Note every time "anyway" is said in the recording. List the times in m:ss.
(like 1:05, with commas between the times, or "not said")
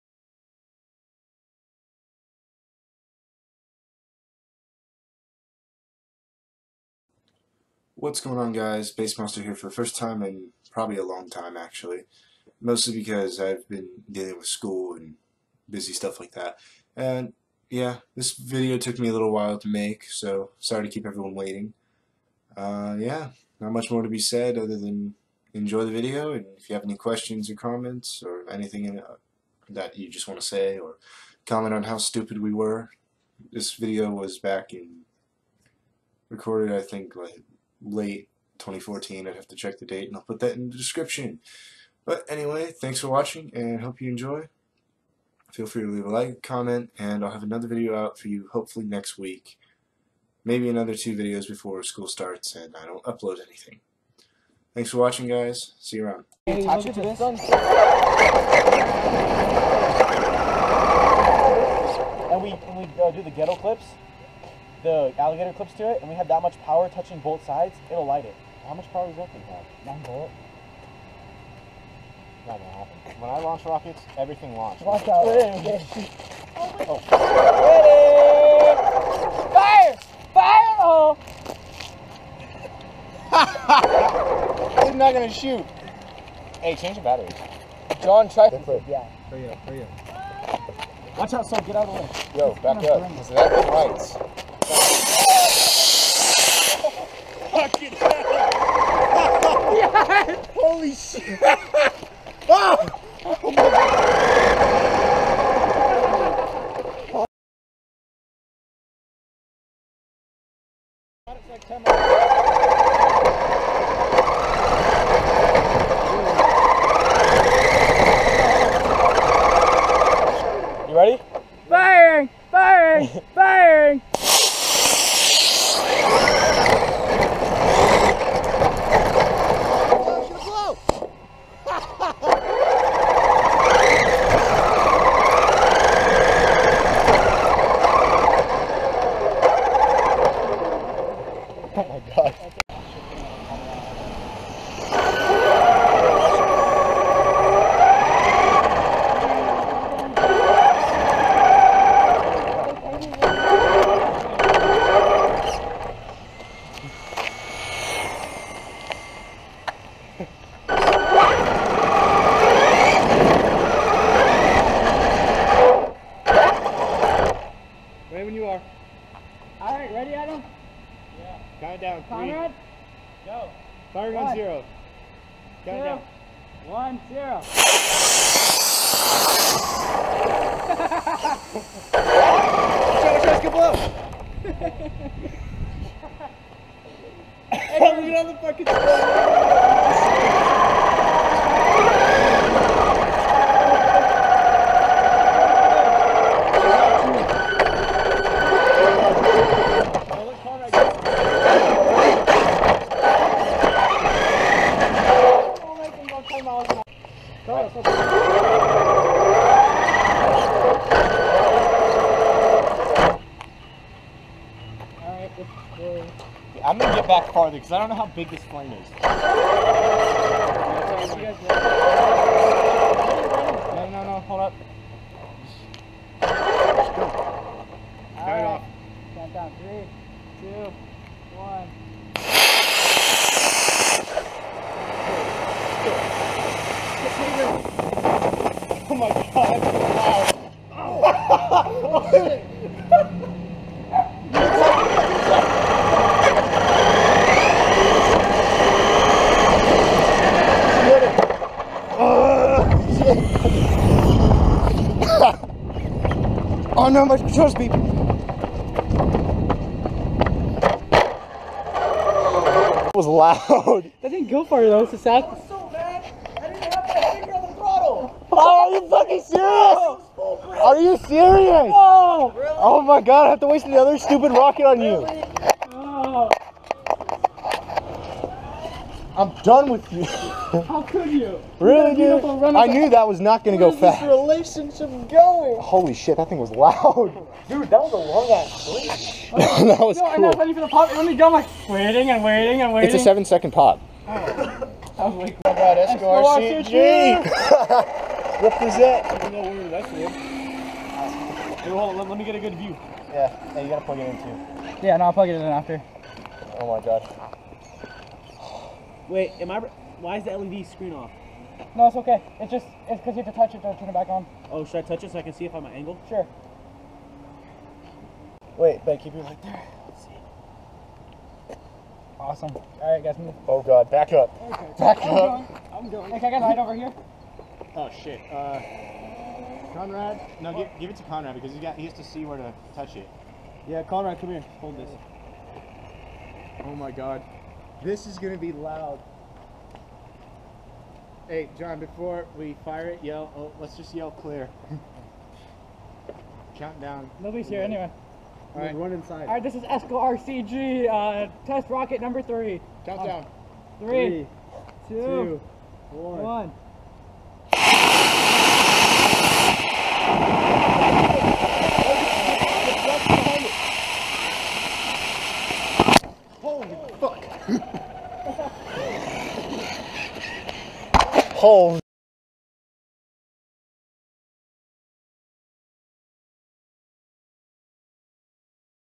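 0:42, 5:47.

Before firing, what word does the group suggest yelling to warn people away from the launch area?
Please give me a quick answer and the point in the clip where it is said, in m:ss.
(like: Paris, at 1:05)
clear, at 5:44.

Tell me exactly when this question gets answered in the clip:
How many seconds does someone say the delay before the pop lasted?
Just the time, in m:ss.
4:53.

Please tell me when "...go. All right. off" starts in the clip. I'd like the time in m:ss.
3:46.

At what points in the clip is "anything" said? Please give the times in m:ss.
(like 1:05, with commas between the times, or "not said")
0:28, 0:53.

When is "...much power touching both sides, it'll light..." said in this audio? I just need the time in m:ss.
1:06.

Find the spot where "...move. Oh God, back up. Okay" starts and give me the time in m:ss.
5:23.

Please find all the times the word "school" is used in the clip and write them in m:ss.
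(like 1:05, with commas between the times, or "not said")
0:14, 0:51.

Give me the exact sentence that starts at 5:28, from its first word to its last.
Uh, Conrad, no, give, give, it to Conrad because he's got he has to see where to touch it.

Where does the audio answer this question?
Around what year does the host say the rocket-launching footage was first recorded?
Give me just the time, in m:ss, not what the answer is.
0:38.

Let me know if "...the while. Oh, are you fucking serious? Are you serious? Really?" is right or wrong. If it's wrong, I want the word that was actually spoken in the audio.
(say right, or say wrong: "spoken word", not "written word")
wrong: "throttle", not "while".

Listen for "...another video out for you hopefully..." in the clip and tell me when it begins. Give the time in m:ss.
0:47.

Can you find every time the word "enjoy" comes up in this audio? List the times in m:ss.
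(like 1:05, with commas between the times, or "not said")
0:25, 0:44.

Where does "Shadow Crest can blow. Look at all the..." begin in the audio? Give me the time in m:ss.
3:02.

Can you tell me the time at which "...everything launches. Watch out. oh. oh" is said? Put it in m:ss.
1:14.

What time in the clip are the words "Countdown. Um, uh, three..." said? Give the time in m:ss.
5:52.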